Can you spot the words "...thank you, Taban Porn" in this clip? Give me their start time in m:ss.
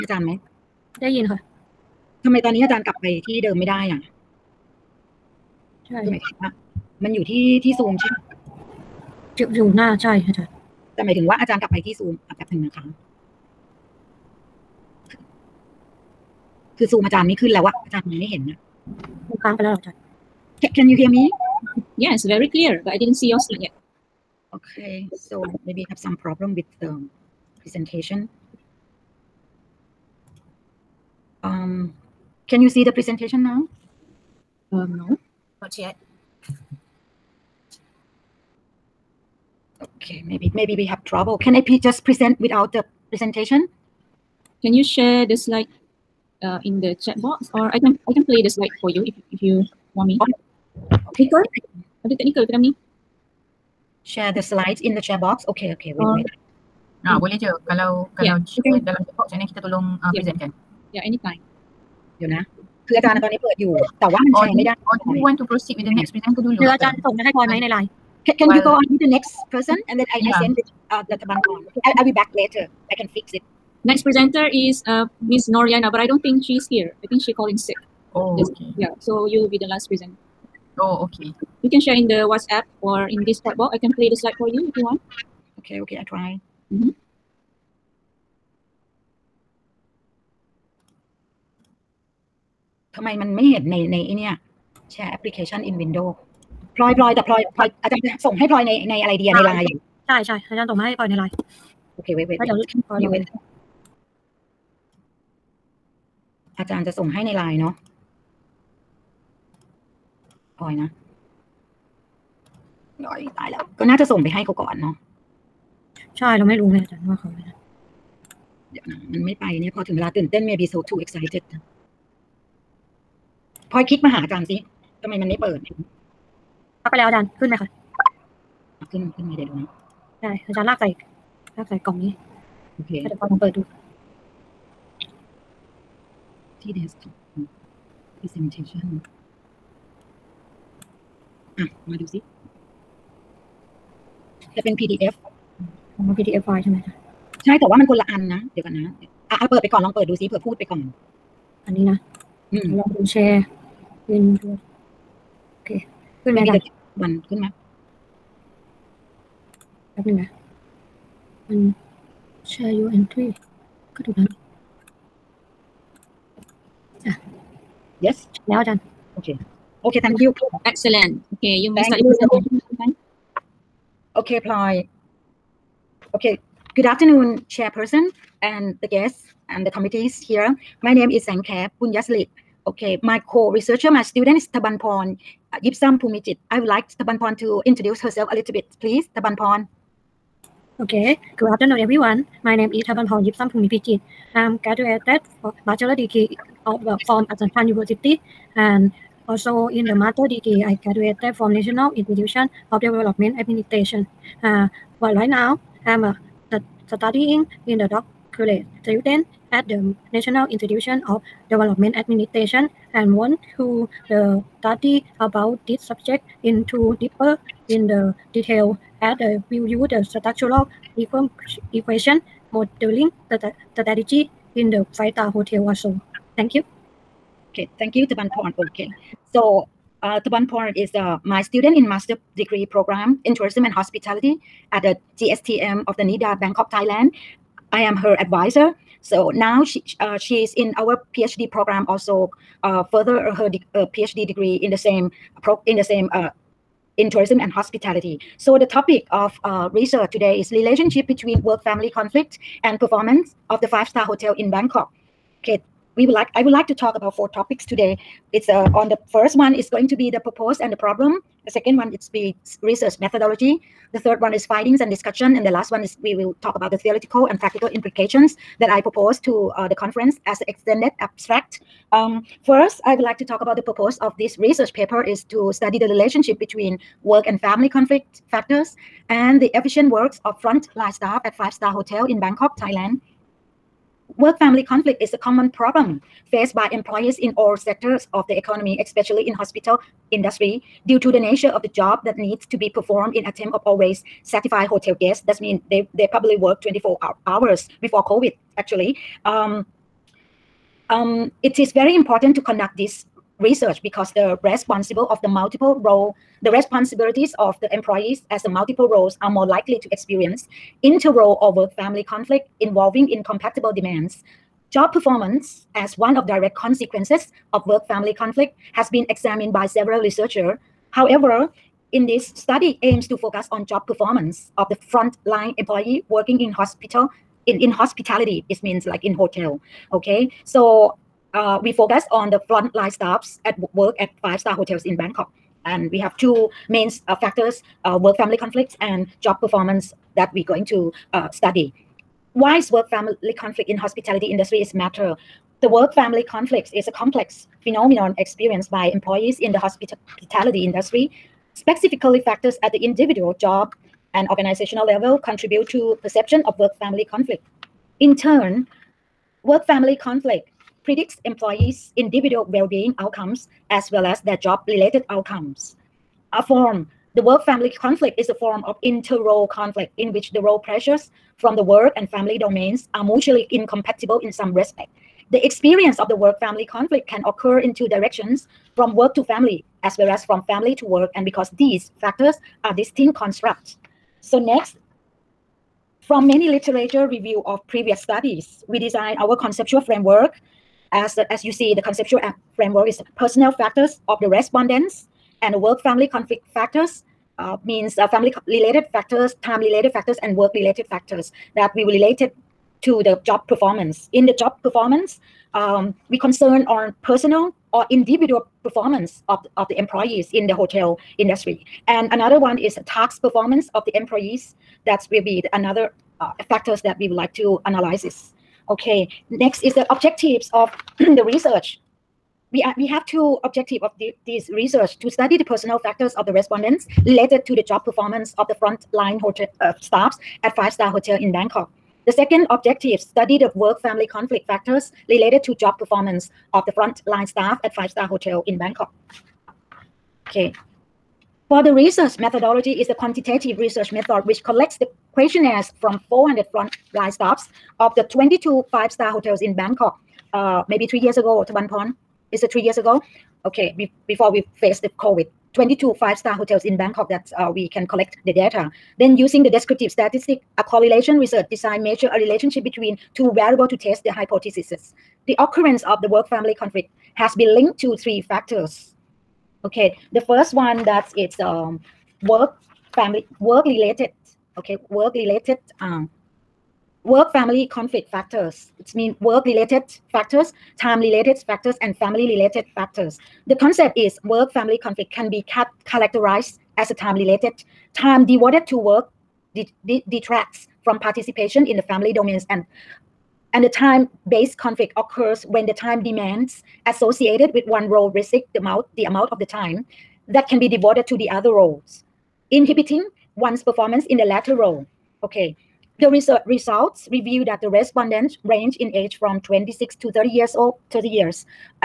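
3:47.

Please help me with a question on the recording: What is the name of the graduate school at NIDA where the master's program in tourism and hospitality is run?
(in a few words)
GSTM.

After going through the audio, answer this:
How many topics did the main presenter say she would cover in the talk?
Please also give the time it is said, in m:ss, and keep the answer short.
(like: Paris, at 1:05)
4, at 4:17.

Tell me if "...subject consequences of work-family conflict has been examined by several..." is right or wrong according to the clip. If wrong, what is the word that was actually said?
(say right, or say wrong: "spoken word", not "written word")
wrong: "direct", not "subject".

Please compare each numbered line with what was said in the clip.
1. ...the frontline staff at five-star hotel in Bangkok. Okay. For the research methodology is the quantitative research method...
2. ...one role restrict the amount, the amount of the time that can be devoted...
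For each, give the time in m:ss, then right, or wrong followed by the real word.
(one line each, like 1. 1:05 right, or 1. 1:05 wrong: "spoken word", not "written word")
1. 7:16 right
2. 8:17 right.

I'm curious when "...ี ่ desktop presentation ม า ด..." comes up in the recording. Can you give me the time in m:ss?
2:16.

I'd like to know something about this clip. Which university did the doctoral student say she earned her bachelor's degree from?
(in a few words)
Assumption University.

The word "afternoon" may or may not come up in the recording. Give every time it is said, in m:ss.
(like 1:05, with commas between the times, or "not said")
2:56, 3:11.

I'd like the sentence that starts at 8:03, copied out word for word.
The concept is work family conflict can be cat- characterized as a time related.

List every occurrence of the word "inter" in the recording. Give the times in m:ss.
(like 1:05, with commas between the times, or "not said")
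5:10, 6:08.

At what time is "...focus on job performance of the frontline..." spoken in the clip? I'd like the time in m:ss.
5:23.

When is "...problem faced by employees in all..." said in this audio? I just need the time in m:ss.
4:45.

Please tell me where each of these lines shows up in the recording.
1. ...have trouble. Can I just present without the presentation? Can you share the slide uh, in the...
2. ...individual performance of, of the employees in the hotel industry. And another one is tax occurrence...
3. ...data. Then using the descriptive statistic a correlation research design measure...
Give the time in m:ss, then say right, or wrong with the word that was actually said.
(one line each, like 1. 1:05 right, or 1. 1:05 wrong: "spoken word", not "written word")
1. 0:40 right
2. 6:47 wrong: "performance", not "occurrence"
3. 7:38 right.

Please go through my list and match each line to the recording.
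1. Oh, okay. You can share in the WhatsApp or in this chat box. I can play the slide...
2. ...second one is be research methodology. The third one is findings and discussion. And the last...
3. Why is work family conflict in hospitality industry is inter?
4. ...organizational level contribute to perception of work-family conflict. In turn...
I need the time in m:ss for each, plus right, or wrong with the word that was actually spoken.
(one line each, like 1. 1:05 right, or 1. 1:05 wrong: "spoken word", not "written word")
1. 1:20 right
2. 4:21 right
3. 5:42 wrong: "matter", not "inter"
4. 5:54 right.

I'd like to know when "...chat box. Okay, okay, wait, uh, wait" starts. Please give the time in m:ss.
0:55.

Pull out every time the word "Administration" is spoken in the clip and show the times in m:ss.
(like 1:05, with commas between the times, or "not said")
3:23, 3:31.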